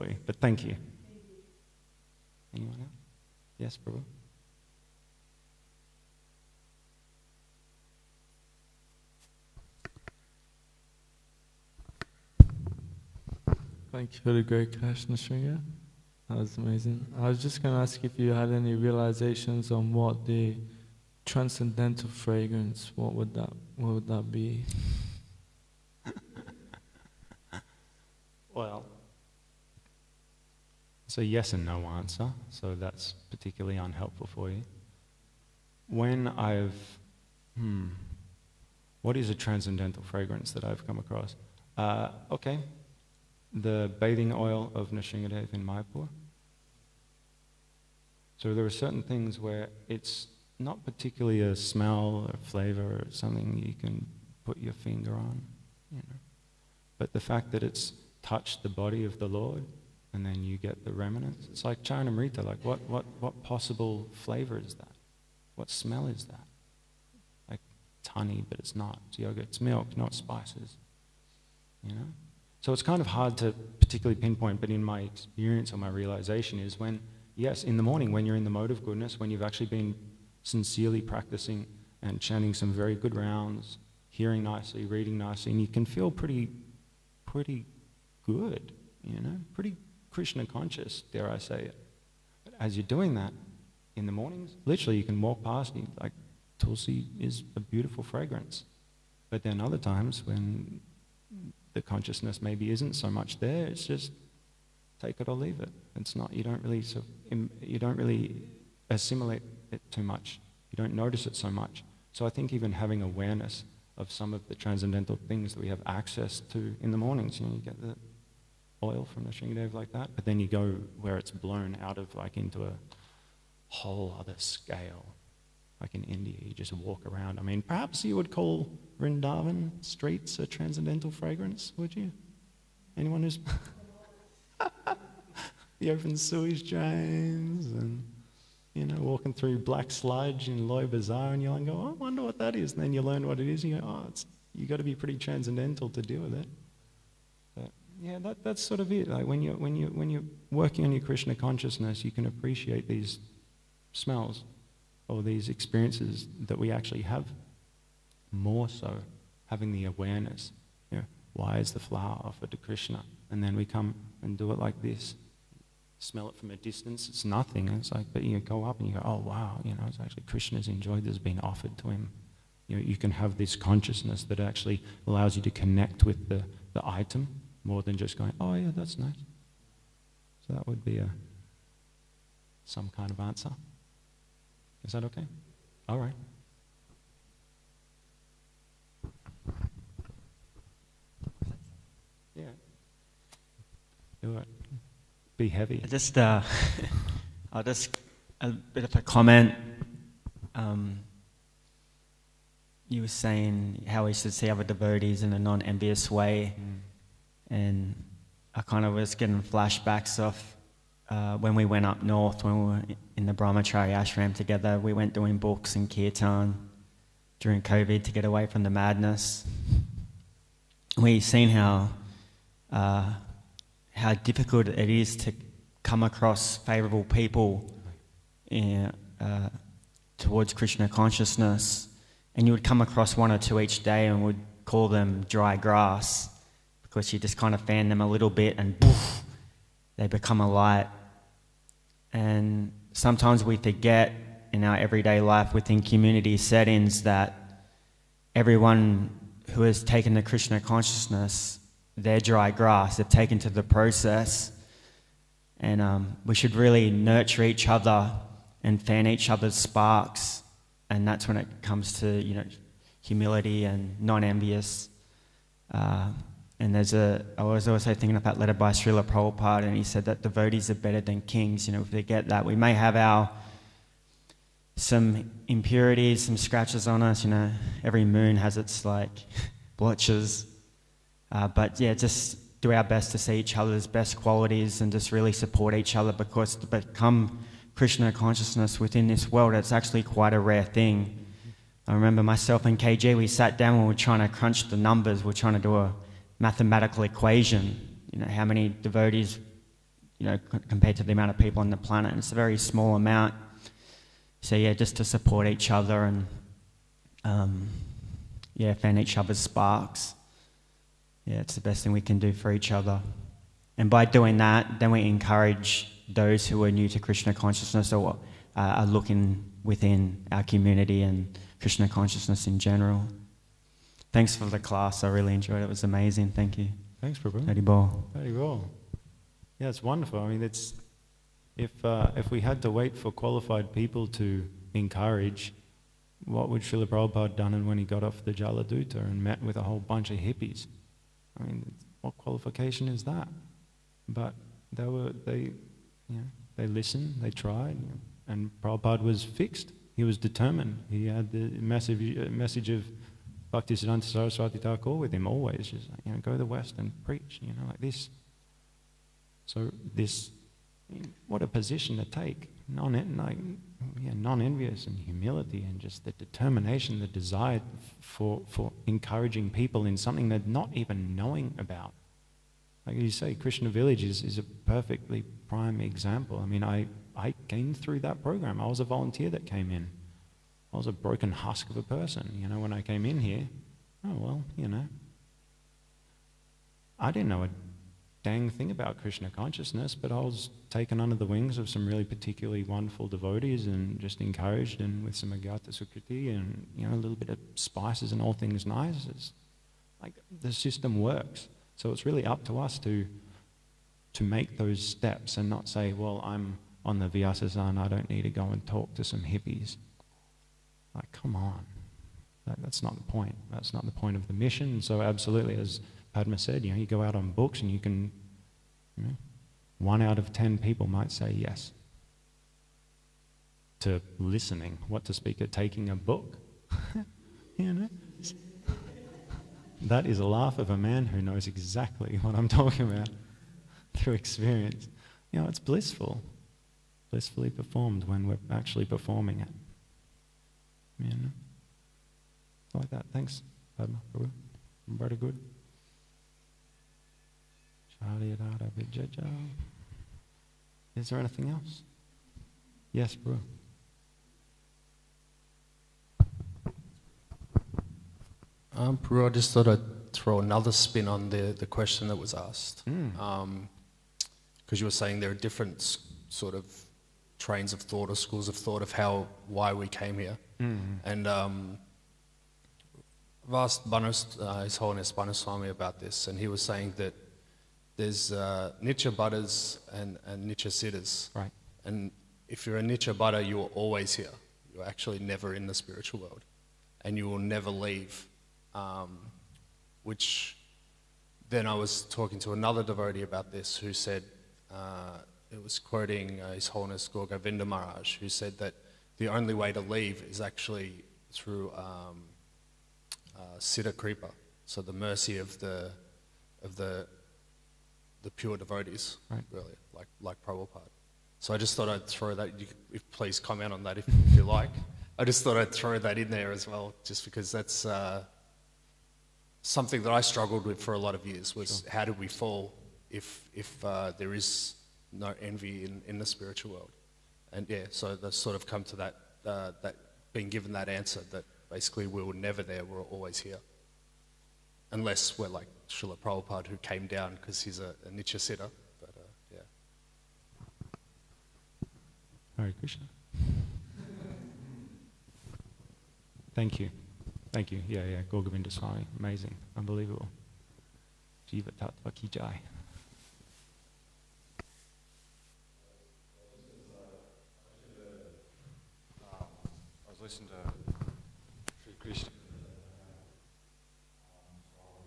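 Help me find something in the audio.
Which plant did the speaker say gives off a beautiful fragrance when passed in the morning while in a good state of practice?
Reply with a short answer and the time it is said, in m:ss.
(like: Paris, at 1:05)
Tulsi, at 1:36.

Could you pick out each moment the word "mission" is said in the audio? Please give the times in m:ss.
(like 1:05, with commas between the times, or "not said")
6:54.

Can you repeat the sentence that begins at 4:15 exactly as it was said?
And um, we should really nurture each other and fan each other's sparks.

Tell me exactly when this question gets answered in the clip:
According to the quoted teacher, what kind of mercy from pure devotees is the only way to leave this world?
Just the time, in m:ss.
8:23.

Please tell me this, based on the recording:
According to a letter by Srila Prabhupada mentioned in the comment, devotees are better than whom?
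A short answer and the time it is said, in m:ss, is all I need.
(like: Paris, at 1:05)
Kings, at 4:31.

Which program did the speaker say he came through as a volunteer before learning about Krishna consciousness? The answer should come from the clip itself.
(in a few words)
Krishna Village.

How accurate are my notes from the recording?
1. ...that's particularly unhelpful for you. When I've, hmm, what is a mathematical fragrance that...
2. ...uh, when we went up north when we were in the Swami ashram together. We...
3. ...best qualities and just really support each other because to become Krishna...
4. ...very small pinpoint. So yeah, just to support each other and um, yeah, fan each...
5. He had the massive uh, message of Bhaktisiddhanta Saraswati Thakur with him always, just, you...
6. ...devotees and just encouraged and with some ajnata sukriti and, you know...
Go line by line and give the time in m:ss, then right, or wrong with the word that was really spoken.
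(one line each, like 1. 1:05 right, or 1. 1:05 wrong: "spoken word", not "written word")
1. 0:32 wrong: "transcendental", not "mathematical"
2. 3:31 wrong: "Brahmachari", not "Swami"
3. 4:43 right
4. 5:02 wrong: "amount", not "pinpoint"
5. 5:50 right
6. 6:33 right.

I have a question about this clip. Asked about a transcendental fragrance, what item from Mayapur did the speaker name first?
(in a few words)
Bathing oil of Nrsimhadev.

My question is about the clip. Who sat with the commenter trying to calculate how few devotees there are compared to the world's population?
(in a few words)
KG.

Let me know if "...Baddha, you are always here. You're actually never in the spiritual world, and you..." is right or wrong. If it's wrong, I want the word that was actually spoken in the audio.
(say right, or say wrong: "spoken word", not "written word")
right.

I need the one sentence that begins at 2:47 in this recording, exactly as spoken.
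It's like, but you go up and you go, oh wow, you know, it's actually Krishna's enjoyed this being offered to him.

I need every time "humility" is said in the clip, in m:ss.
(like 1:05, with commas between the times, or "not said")
4:22, 6:04.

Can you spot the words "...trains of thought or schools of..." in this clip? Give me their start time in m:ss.
7:47.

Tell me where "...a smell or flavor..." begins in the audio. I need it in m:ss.
0:51.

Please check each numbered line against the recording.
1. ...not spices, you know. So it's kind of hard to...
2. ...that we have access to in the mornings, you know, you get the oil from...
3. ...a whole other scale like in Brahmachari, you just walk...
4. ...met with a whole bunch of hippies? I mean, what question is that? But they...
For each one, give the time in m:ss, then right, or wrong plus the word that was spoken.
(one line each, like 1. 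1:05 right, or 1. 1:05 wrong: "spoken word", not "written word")
1. 1:09 right
2. 1:55 right
3. 2:02 wrong: "India", not "Brahmachari"
4. 5:39 wrong: "qualification", not "question".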